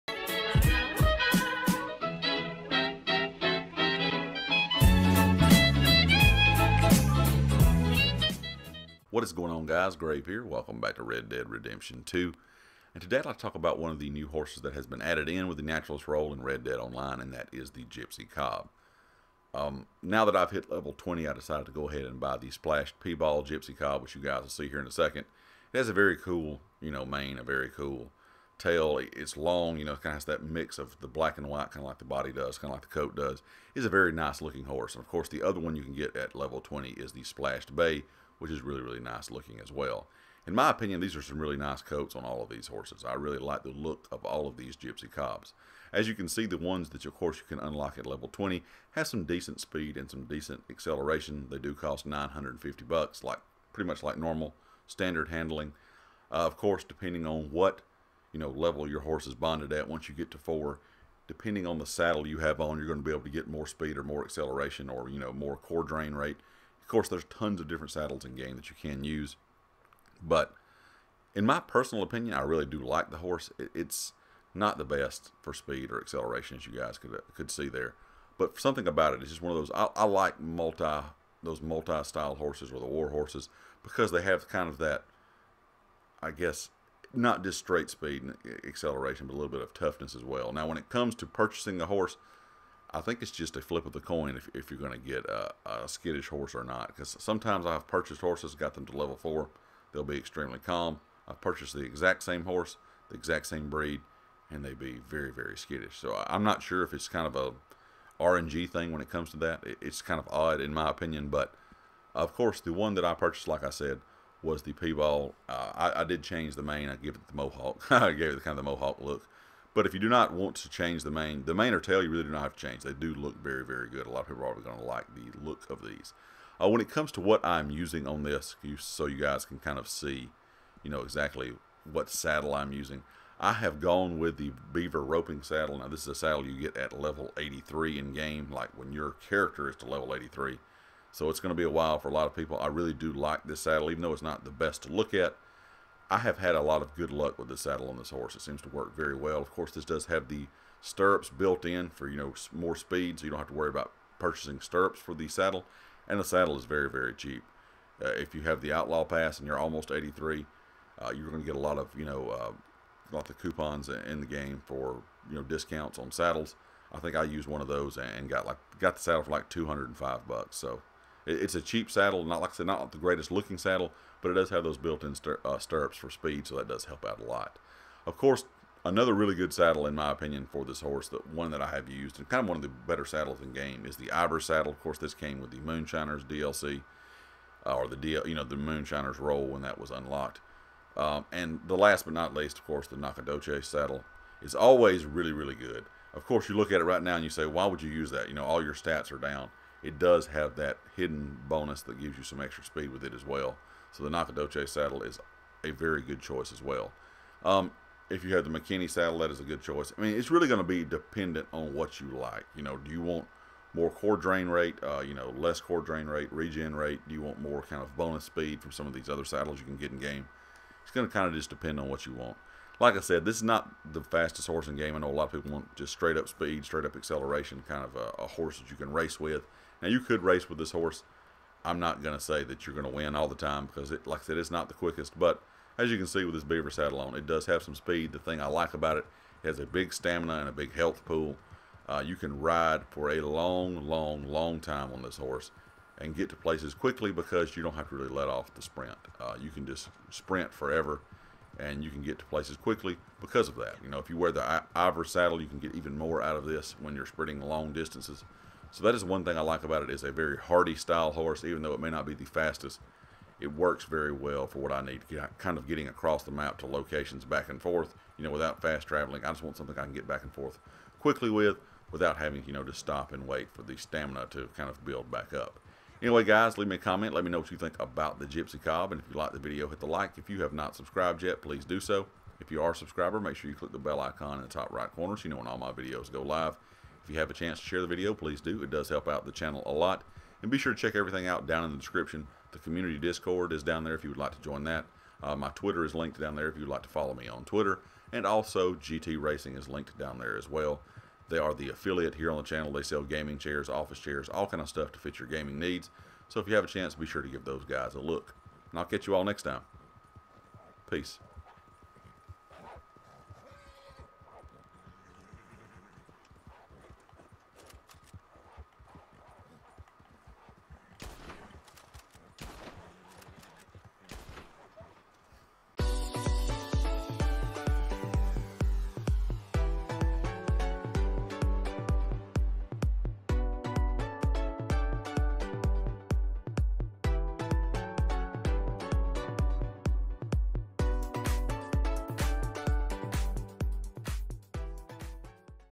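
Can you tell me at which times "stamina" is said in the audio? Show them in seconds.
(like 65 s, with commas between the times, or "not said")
239 s, 273 s.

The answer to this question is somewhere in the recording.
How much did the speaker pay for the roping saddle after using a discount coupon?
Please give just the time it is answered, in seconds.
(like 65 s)
169 s.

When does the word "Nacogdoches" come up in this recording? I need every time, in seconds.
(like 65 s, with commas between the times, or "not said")
192 s, 204 s.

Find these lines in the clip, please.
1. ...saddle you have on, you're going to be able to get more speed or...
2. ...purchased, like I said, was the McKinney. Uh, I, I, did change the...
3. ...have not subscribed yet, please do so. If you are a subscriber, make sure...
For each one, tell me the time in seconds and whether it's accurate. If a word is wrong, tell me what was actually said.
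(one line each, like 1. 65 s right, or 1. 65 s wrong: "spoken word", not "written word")
1. 61 s right
2. 113 s wrong: "Piebald", not "McKinney"
3. 280 s right.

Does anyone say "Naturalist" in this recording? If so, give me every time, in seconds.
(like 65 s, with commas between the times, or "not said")
15 s.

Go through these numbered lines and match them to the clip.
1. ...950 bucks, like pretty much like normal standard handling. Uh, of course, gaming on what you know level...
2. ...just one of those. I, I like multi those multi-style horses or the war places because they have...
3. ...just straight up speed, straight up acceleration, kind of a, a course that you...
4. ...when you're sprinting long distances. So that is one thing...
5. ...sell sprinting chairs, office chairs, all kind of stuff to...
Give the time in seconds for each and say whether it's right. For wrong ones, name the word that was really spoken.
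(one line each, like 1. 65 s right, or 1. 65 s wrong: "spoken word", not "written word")
1. 52 s wrong: "depending", not "gaming"
2. 79 s wrong: "horses", not "places"
3. 225 s wrong: "horse", not "course"
4. 256 s right
5. 302 s wrong: "gaming", not "sprinting".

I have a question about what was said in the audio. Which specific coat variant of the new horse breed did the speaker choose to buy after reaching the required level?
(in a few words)
Splashed Piebald.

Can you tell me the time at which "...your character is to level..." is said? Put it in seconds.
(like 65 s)
138 s.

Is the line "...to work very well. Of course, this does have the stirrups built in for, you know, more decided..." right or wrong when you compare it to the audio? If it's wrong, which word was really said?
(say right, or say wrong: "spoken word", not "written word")
wrong: "speed", not "decided".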